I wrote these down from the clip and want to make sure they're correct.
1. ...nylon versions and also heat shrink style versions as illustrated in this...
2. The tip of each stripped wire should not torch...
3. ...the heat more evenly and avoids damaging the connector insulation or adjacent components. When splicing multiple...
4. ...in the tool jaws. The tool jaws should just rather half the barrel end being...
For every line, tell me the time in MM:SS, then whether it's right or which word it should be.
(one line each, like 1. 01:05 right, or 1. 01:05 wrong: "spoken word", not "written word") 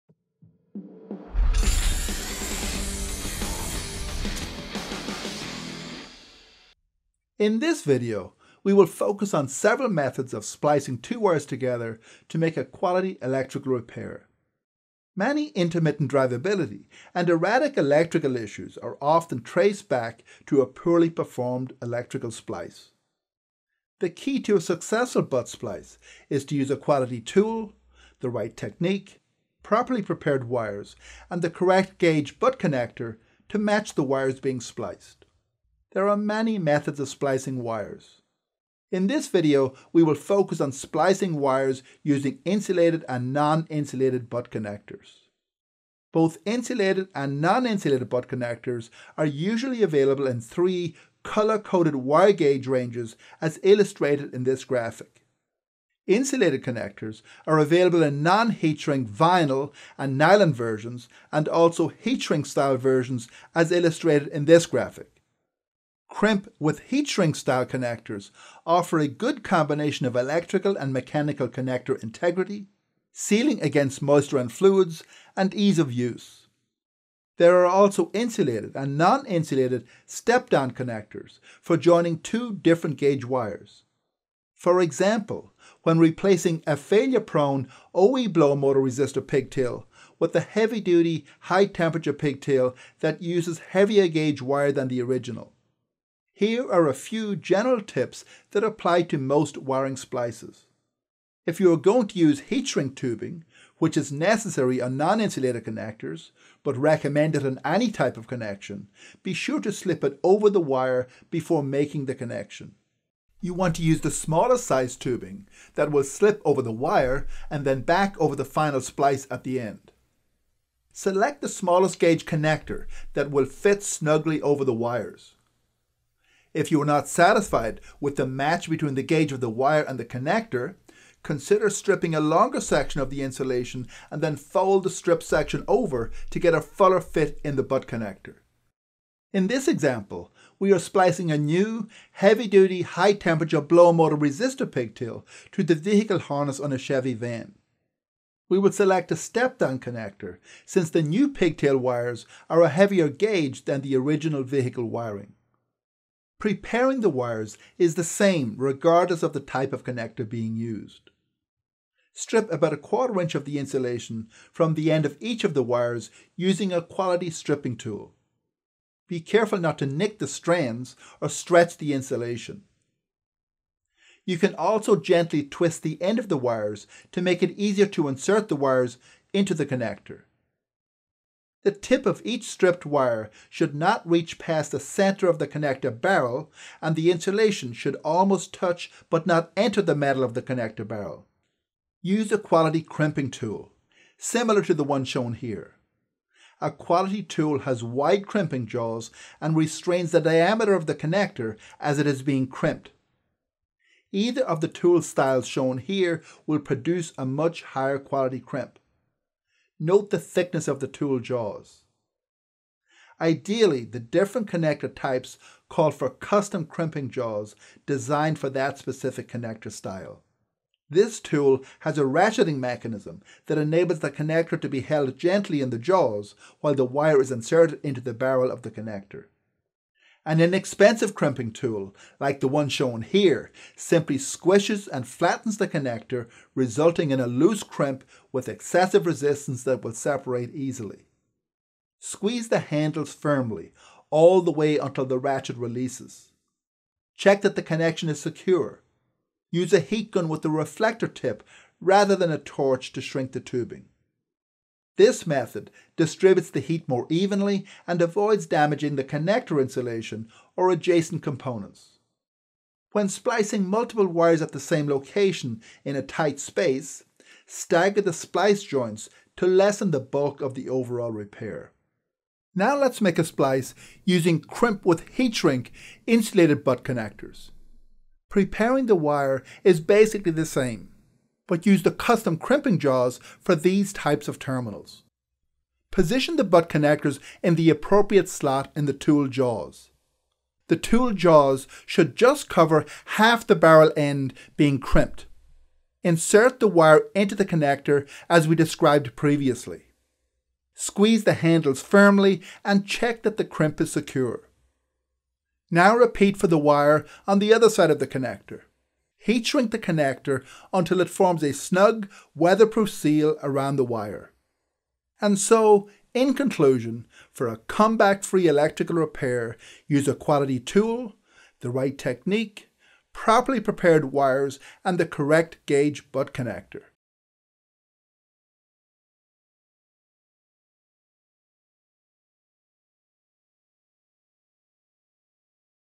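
1. 01:00 right
2. 03:01 wrong: "reach", not "torch"
3. 04:16 right
4. 04:48 wrong: "cover", not "rather".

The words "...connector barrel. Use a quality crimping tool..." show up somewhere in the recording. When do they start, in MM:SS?
03:10.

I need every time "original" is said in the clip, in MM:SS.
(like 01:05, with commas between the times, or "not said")
01:35, 02:33.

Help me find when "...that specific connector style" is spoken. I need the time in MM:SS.
03:38.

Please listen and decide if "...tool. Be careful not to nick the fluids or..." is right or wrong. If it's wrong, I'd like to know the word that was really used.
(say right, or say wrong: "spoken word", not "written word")
wrong: "strands", not "fluids".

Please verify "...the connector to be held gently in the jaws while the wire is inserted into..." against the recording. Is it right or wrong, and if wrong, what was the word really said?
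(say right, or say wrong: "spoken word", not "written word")
right.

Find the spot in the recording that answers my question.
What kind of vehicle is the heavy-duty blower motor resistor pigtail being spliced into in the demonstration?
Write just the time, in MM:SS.
02:26.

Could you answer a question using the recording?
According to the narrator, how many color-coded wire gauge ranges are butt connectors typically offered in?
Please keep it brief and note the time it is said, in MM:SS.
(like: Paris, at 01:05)
3, at 00:50.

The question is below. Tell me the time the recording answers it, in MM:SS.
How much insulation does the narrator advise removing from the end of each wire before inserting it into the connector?
02:42.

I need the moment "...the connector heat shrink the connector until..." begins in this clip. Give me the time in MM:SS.
05:07.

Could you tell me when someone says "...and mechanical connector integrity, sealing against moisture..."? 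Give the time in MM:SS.
01:10.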